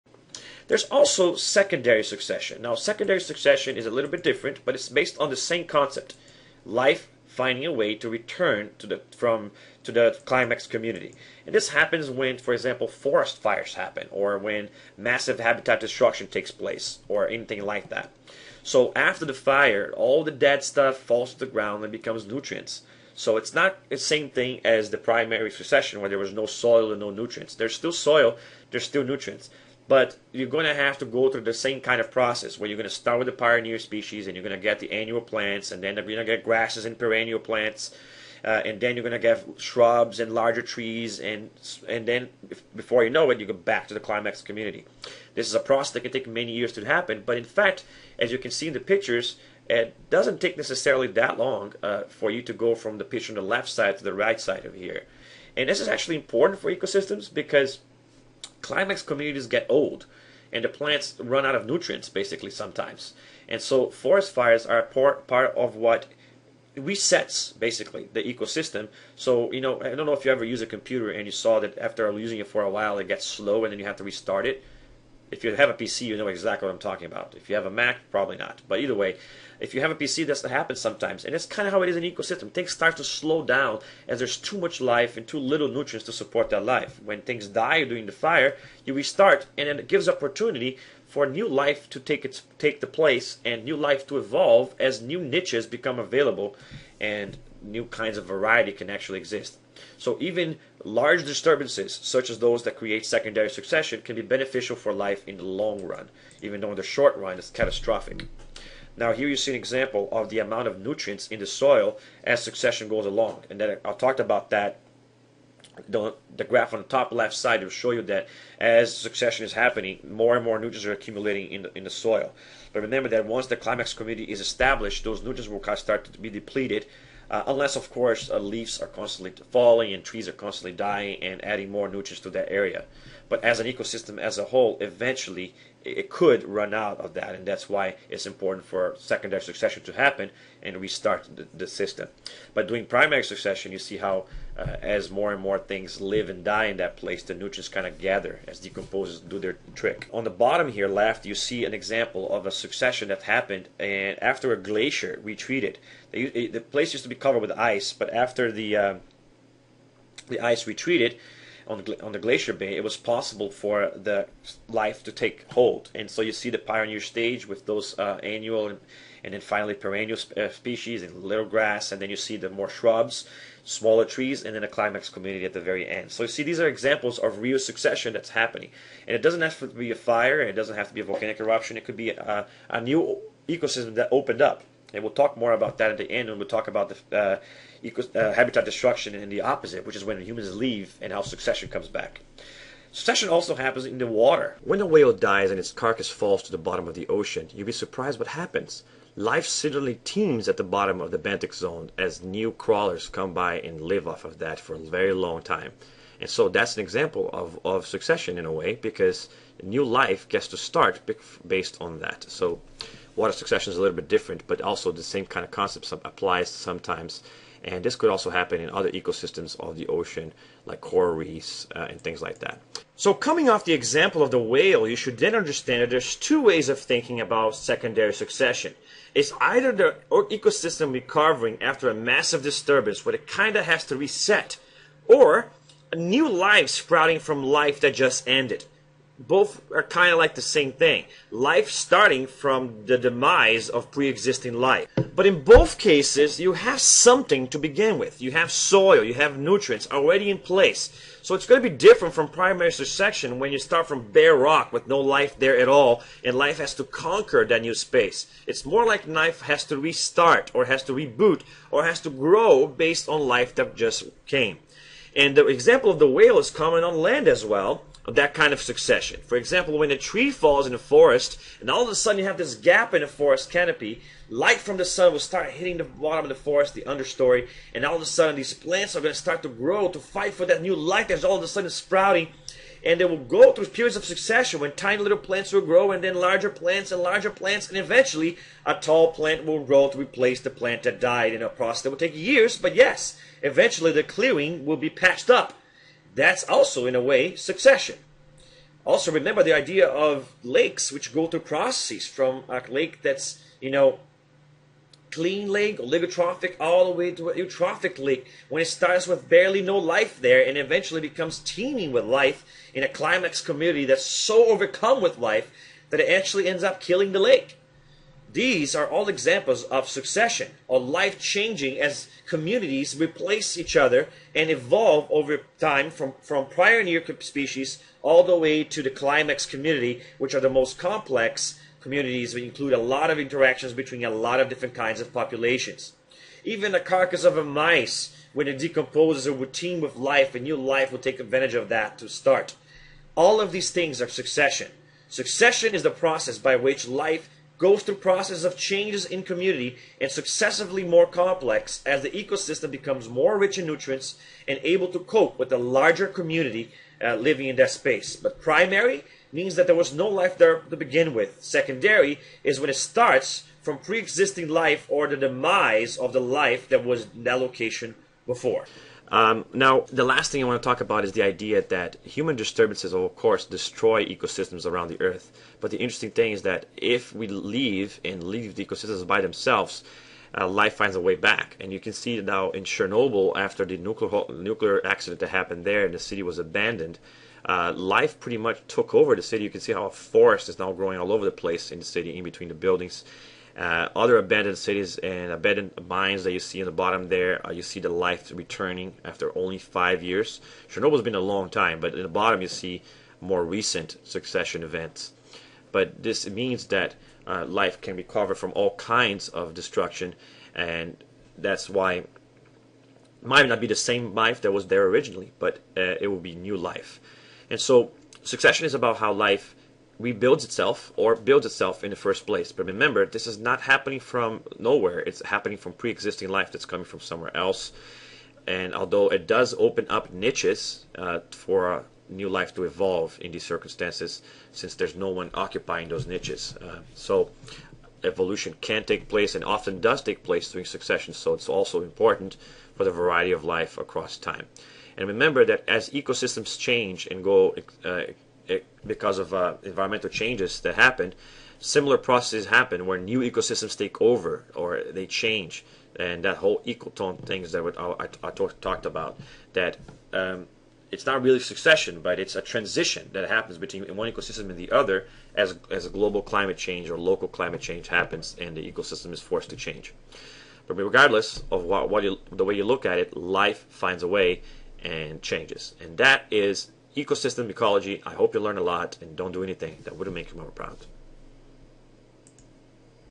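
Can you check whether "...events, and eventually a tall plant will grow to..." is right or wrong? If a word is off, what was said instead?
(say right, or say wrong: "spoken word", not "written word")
wrong: "plants", not "events".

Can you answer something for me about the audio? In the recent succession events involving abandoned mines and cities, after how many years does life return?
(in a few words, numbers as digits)
5 years.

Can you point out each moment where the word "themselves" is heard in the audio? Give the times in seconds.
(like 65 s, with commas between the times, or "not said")
379 s.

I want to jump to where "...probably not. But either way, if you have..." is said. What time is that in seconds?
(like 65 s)
78 s.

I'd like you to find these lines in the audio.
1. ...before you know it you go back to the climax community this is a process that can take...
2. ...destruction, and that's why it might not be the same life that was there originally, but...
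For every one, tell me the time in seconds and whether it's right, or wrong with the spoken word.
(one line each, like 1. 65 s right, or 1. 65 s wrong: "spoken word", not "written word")
1. 42 s right
2. 409 s right.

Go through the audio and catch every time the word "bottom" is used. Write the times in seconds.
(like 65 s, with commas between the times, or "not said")
150 s, 196 s, 200 s, 275 s, 396 s, 402 s.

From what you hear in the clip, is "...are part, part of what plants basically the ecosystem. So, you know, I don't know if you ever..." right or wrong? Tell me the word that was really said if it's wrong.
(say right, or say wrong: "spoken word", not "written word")
wrong: "resets", not "plants".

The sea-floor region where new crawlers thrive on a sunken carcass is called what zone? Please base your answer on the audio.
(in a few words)
benthic zone.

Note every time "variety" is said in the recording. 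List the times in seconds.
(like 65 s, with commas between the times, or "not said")
98 s, 442 s.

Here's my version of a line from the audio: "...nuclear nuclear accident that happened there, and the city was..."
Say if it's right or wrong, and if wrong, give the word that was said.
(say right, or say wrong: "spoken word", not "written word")
right.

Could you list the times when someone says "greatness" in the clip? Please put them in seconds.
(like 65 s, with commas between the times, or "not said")
not said.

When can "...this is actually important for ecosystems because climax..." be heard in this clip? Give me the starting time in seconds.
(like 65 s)
55 s.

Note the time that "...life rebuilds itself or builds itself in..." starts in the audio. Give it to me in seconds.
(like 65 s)
419 s.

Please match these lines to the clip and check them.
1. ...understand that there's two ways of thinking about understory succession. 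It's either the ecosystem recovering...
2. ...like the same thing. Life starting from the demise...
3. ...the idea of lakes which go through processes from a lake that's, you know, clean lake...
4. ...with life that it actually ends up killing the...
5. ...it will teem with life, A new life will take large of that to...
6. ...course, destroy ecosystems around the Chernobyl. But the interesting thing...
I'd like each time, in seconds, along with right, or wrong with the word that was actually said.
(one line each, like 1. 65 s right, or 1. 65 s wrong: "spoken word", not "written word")
1. 225 s wrong: "secondary", not "understory"
2. 240 s right
3. 299 s right
4. 315 s right
5. 339 s wrong: "advantage", not "large"
6. 373 s wrong: "Earth", not "Chernobyl".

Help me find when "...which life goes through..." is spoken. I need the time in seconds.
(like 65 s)
346 s.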